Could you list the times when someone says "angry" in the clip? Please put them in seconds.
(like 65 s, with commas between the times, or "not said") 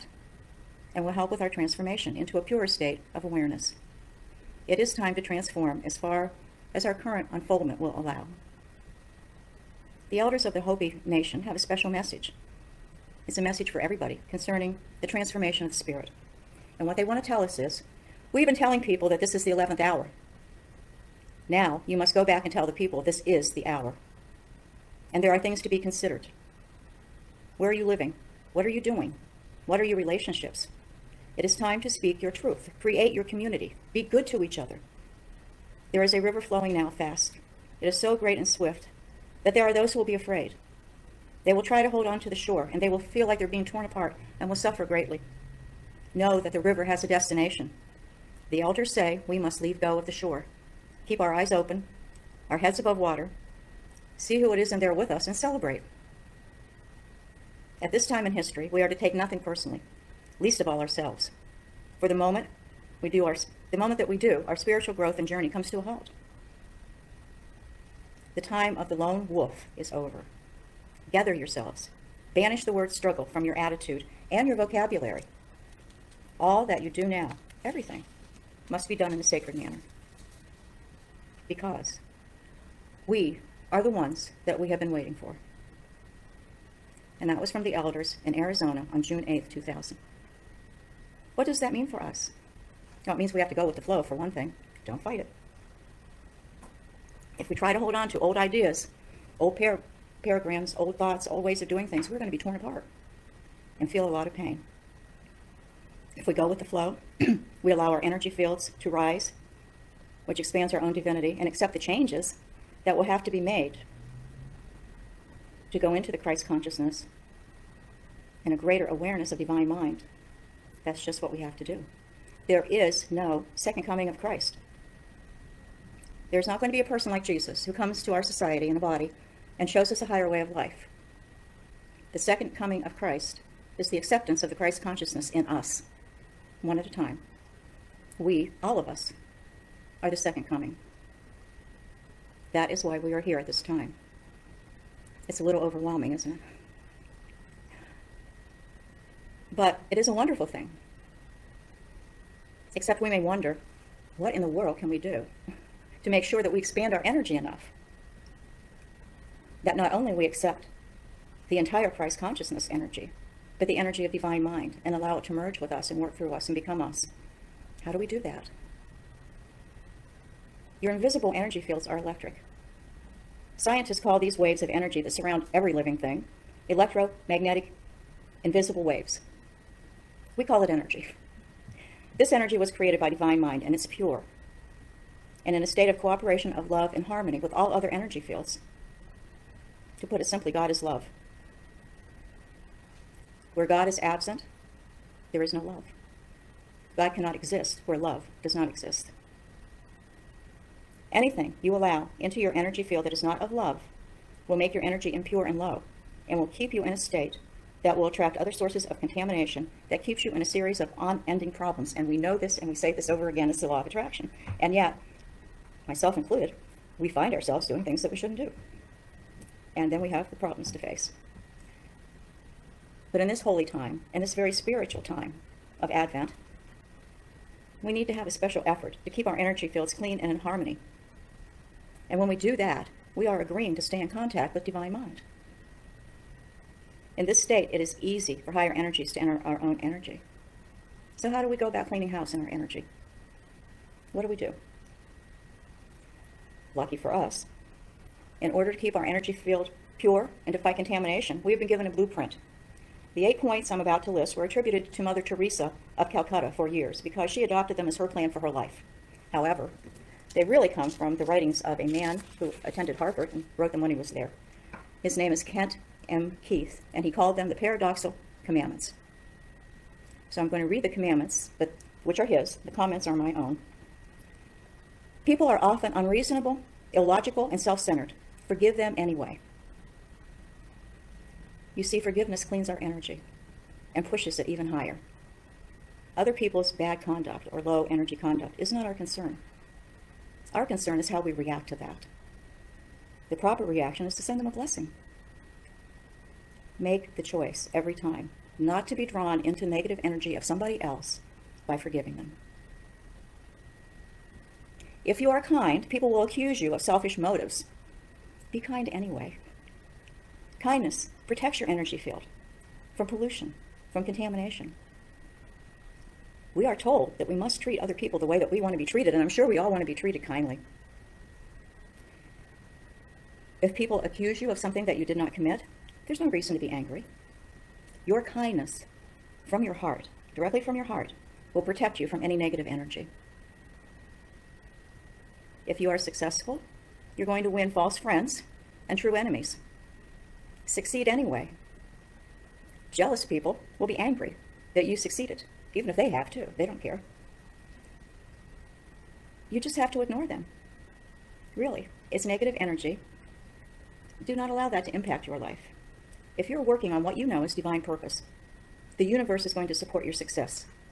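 326 s, 343 s.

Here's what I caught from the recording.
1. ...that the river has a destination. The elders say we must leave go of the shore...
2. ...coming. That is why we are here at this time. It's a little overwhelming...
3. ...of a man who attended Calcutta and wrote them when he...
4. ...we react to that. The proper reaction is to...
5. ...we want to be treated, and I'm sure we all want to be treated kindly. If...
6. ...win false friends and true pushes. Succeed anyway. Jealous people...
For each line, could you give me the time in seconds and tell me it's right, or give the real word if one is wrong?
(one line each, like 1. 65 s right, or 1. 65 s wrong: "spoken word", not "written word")
1. 46 s right
2. 140 s right
3. 261 s wrong: "Harvard", not "Calcutta"
4. 291 s right
5. 318 s right
6. 337 s wrong: "enemies", not "pushes".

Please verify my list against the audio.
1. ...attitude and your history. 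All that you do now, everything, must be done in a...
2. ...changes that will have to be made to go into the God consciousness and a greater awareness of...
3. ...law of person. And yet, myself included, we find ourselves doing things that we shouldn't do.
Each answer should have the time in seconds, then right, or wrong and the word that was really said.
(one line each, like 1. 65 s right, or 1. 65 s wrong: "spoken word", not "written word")
1. 73 s wrong: "vocabulary", not "history"
2. 111 s wrong: "Christ", not "God"
3. 213 s wrong: "attraction", not "person".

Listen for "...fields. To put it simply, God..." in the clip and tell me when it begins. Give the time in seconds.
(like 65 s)
188 s.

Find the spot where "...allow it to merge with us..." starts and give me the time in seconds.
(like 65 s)
164 s.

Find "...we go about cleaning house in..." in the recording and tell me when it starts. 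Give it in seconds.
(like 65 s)
241 s.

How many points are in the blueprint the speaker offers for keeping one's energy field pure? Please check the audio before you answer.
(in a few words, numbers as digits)
8.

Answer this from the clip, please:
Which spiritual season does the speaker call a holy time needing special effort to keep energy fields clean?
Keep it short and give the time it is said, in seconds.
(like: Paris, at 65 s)
Advent, at 225 s.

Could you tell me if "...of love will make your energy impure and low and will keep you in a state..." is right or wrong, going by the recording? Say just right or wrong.
right.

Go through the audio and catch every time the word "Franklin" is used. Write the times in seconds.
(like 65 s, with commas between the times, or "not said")
not said.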